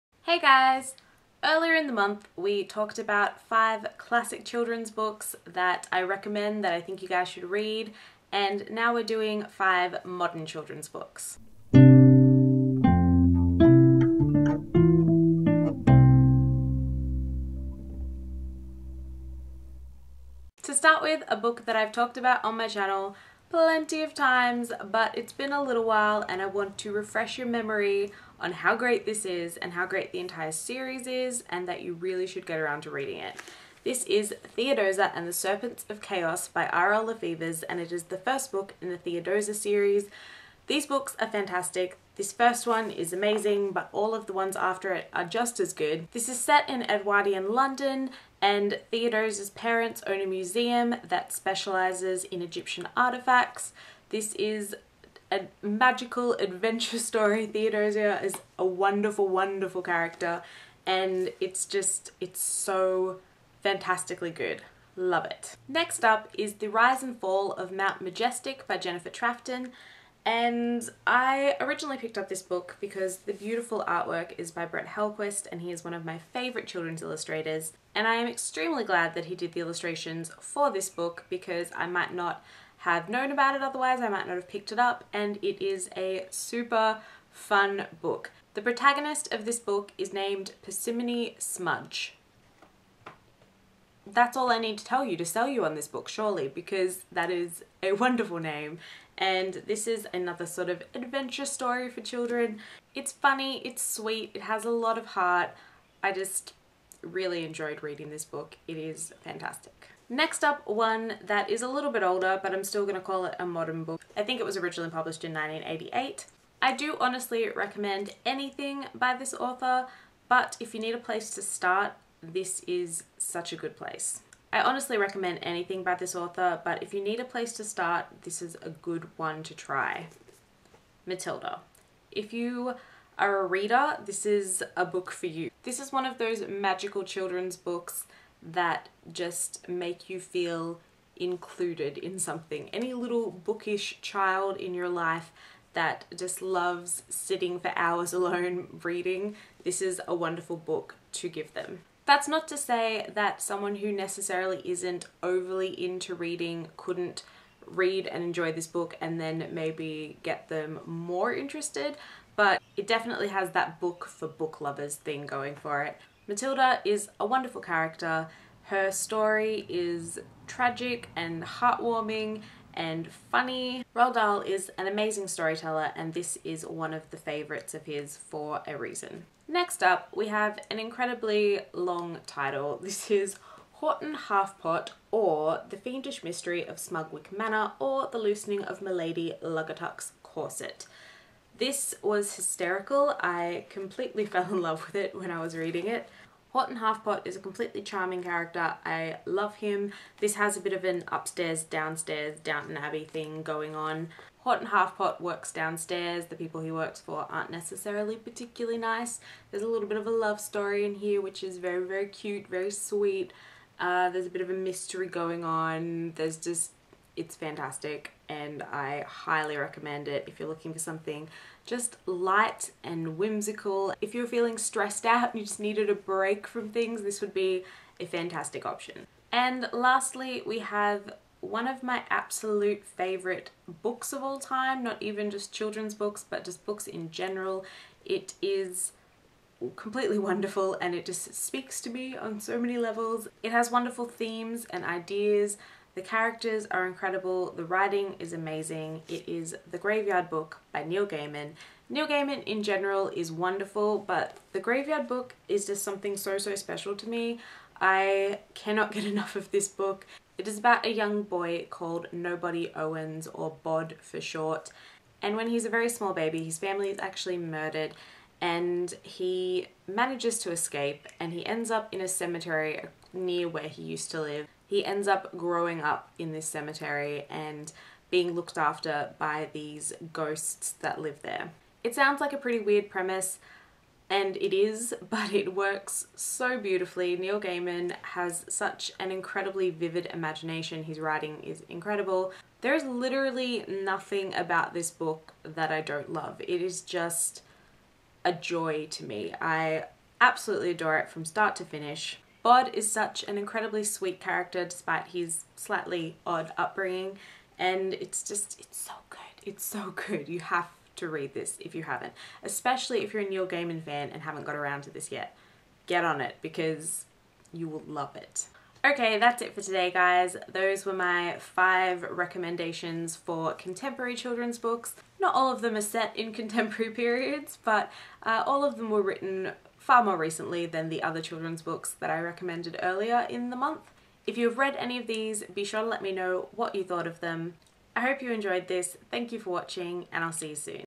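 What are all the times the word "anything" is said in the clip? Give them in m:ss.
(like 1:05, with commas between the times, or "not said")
1:58, 2:05.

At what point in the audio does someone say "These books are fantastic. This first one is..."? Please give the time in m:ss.
0:40.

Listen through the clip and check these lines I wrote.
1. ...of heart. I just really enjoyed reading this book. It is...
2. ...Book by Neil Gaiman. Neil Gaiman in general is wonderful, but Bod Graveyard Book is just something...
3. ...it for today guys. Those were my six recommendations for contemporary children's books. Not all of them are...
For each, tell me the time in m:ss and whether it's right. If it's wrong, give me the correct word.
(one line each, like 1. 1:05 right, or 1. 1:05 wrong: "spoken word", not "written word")
1. 1:44 right
2. 4:10 wrong: "The", not "Bod"
3. 5:19 wrong: "five", not "six".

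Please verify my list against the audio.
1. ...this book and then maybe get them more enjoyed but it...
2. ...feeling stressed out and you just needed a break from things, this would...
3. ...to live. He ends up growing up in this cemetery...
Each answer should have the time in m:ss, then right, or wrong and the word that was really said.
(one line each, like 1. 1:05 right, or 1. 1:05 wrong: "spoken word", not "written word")
1. 2:38 wrong: "interested", not "enjoyed"
2. 3:44 right
3. 4:34 right.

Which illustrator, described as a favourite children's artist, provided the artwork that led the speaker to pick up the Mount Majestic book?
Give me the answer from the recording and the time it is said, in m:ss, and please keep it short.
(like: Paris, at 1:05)
Brett Helquist, at 1:14.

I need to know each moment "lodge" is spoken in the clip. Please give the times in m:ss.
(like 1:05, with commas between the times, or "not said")
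not said.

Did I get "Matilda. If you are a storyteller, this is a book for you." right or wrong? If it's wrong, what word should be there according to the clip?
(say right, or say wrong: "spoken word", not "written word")
wrong: "reader", not "storyteller".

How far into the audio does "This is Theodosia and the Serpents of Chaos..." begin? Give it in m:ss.
0:33.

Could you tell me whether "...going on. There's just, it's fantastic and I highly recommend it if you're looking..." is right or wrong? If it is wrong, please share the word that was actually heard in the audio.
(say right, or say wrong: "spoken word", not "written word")
right.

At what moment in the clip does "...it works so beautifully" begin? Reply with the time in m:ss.
4:45.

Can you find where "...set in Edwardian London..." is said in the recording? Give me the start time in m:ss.
0:46.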